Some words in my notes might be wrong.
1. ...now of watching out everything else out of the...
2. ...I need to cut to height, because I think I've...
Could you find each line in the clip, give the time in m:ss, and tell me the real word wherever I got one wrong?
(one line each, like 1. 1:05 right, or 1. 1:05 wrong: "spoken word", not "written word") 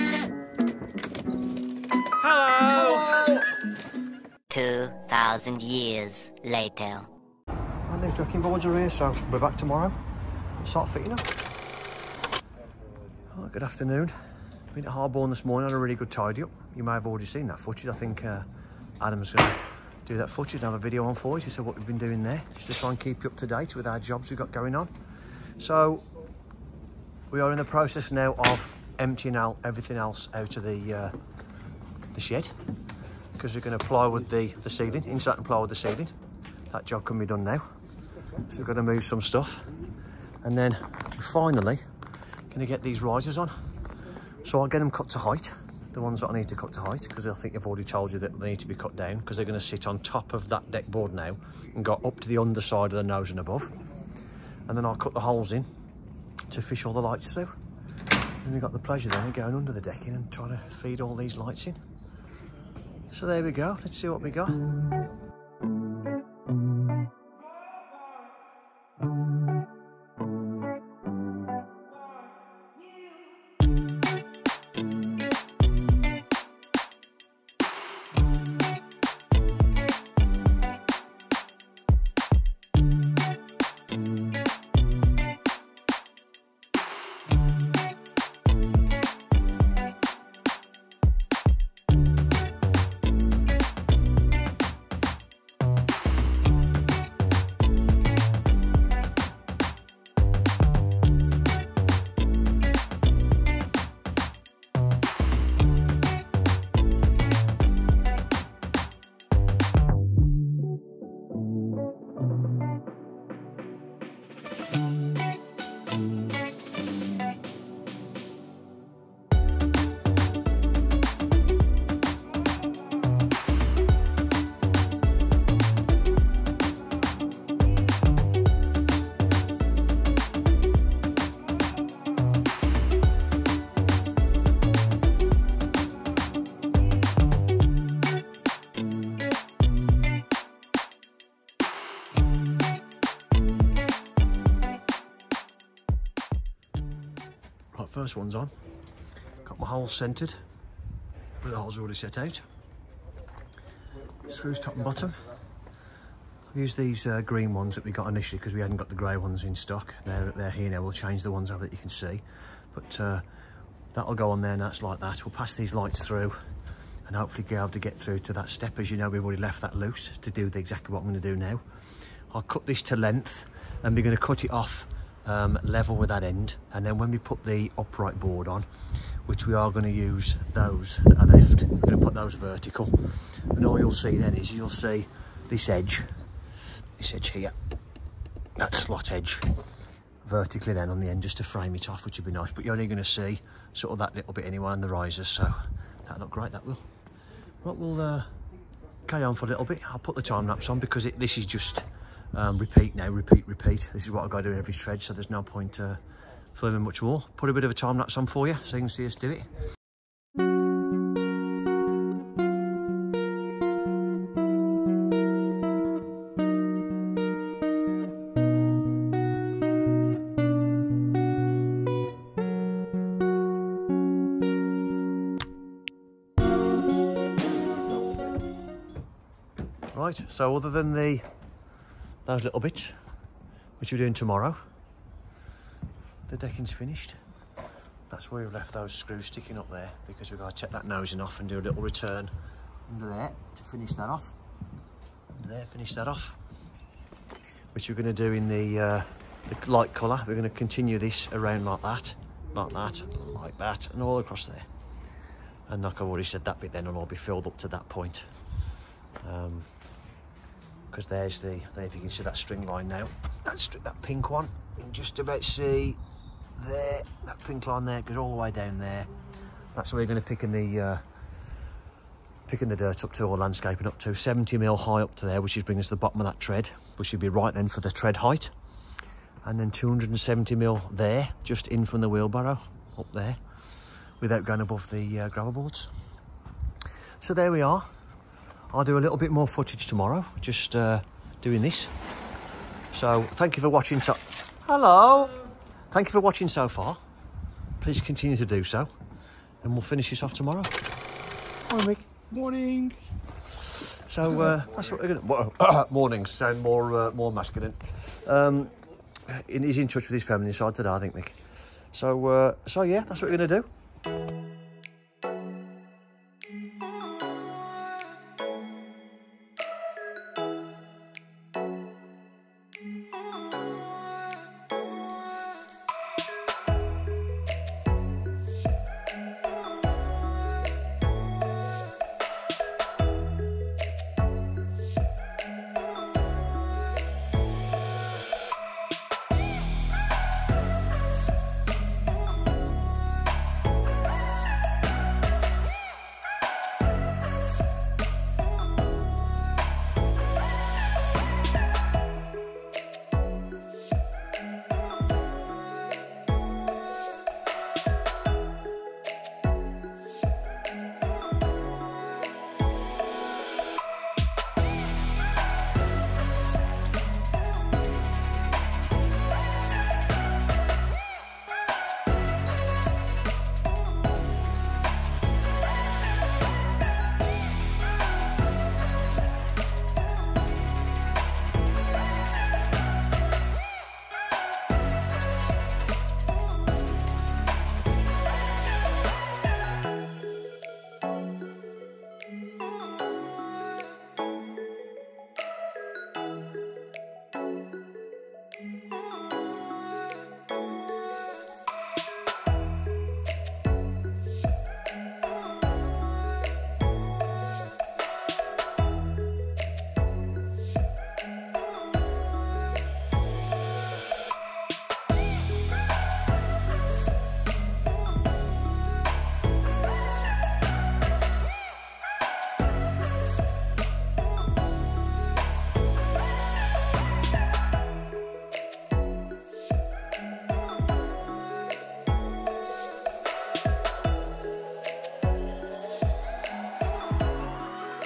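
1. 0:28 wrong: "emptying", not "watching"
2. 0:46 right.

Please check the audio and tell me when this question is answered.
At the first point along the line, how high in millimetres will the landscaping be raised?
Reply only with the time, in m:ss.
4:34.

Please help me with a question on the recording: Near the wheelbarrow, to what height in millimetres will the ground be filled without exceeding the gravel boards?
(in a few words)
270.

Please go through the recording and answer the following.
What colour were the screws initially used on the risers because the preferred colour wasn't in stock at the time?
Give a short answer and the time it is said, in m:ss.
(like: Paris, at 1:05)
green, at 2:37.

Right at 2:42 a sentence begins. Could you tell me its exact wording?
But uh, that'll go on there and that's like that.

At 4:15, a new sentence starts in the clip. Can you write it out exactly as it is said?
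And like I've already said, that bit then will all be filled up to that point.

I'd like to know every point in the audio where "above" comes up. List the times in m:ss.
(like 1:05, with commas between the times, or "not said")
0:53, 4:44.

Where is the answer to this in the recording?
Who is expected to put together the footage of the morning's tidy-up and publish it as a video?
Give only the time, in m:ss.
0:19.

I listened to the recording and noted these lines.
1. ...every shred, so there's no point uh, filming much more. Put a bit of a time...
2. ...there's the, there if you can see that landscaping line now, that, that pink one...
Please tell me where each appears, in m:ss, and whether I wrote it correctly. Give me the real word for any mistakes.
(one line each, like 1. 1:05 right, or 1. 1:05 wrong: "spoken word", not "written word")
1. 3:24 right
2. 4:21 wrong: "string", not "landscaping".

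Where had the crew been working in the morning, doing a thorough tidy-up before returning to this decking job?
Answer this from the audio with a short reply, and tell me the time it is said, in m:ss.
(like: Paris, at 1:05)
Harborne, at 0:14.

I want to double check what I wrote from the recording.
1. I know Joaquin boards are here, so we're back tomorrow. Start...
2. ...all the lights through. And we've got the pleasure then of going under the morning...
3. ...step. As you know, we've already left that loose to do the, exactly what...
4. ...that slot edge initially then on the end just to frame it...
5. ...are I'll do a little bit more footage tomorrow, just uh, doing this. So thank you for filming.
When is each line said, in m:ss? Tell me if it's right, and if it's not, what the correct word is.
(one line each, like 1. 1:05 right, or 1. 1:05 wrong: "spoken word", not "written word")
1. 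0:07 right
2. 0:56 wrong: "decking", not "morning"
3. 2:48 right
4. 3:08 wrong: "vertically", not "initially"
5. 4:47 wrong: "watching", not "filming".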